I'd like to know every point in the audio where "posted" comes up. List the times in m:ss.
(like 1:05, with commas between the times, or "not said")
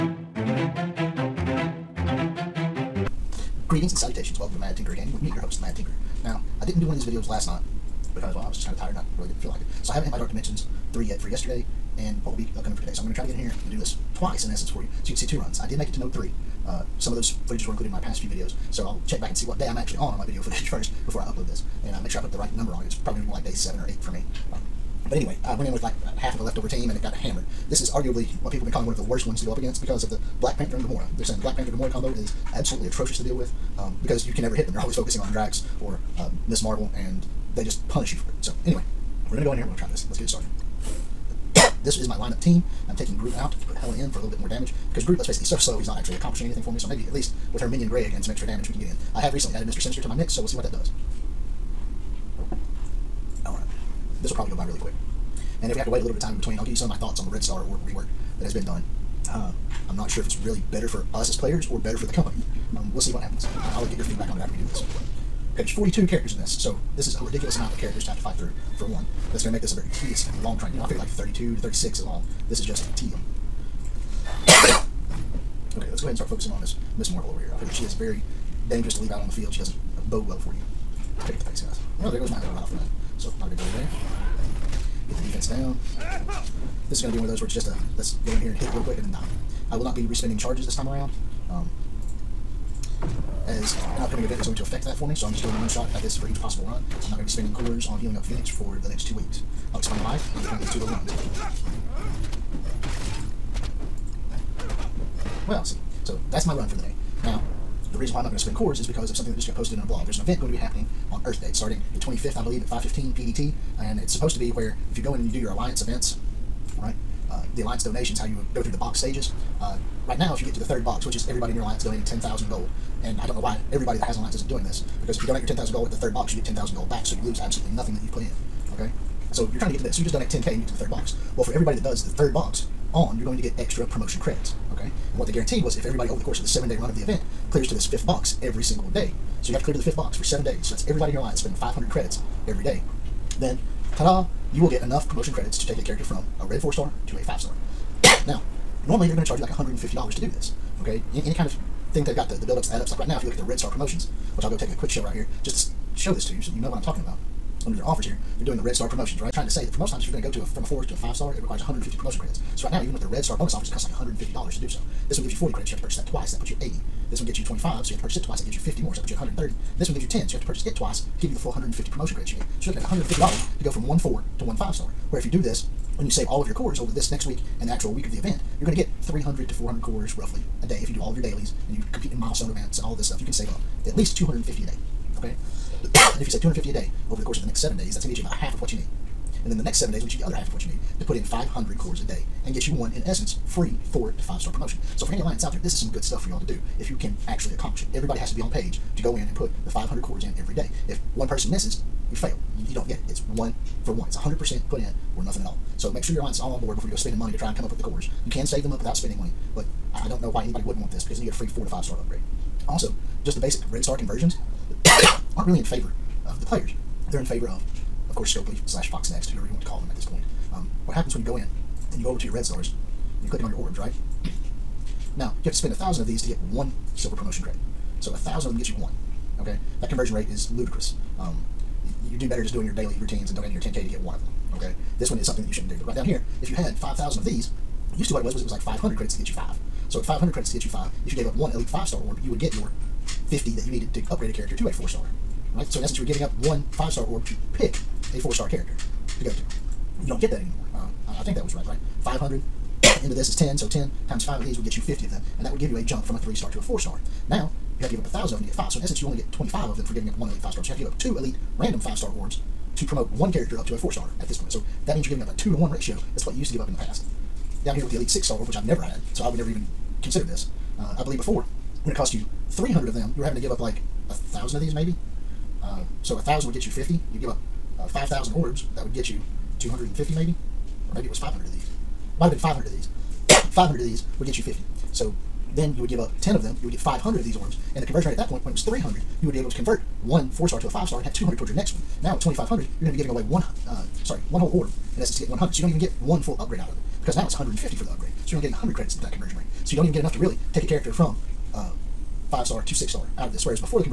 1:49.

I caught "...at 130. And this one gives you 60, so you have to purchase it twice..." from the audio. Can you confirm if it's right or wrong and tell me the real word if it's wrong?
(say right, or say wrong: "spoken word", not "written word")
wrong: "10", not "60".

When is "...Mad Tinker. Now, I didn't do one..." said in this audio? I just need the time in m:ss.
0:05.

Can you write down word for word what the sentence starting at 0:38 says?
So, anyway, we're going to go in here we're going to try this.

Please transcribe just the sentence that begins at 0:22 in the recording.
It's probably going to be more like day seven or eight for me.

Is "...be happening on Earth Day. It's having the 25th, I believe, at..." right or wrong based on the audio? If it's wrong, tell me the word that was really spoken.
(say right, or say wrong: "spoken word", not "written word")
wrong: "starting", not "having".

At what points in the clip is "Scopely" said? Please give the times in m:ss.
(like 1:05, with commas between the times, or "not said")
3:38.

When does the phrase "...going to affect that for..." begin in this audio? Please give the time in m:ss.
1:34.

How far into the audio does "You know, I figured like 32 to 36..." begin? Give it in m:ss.
1:10.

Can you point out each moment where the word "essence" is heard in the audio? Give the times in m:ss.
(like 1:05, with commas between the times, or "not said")
0:14, 3:13, 4:05, 4:18, 4:55.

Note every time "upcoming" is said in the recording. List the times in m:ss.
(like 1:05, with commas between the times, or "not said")
0:12, 1:34.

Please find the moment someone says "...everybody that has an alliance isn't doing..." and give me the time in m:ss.
2:03.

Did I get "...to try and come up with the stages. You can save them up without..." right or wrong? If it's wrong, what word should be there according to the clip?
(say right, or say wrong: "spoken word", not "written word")
wrong: "cores", not "stages".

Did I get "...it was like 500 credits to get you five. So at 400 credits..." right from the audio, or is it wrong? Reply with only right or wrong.
wrong.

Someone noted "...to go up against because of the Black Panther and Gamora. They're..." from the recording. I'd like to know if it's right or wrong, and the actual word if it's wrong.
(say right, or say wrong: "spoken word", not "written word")
right.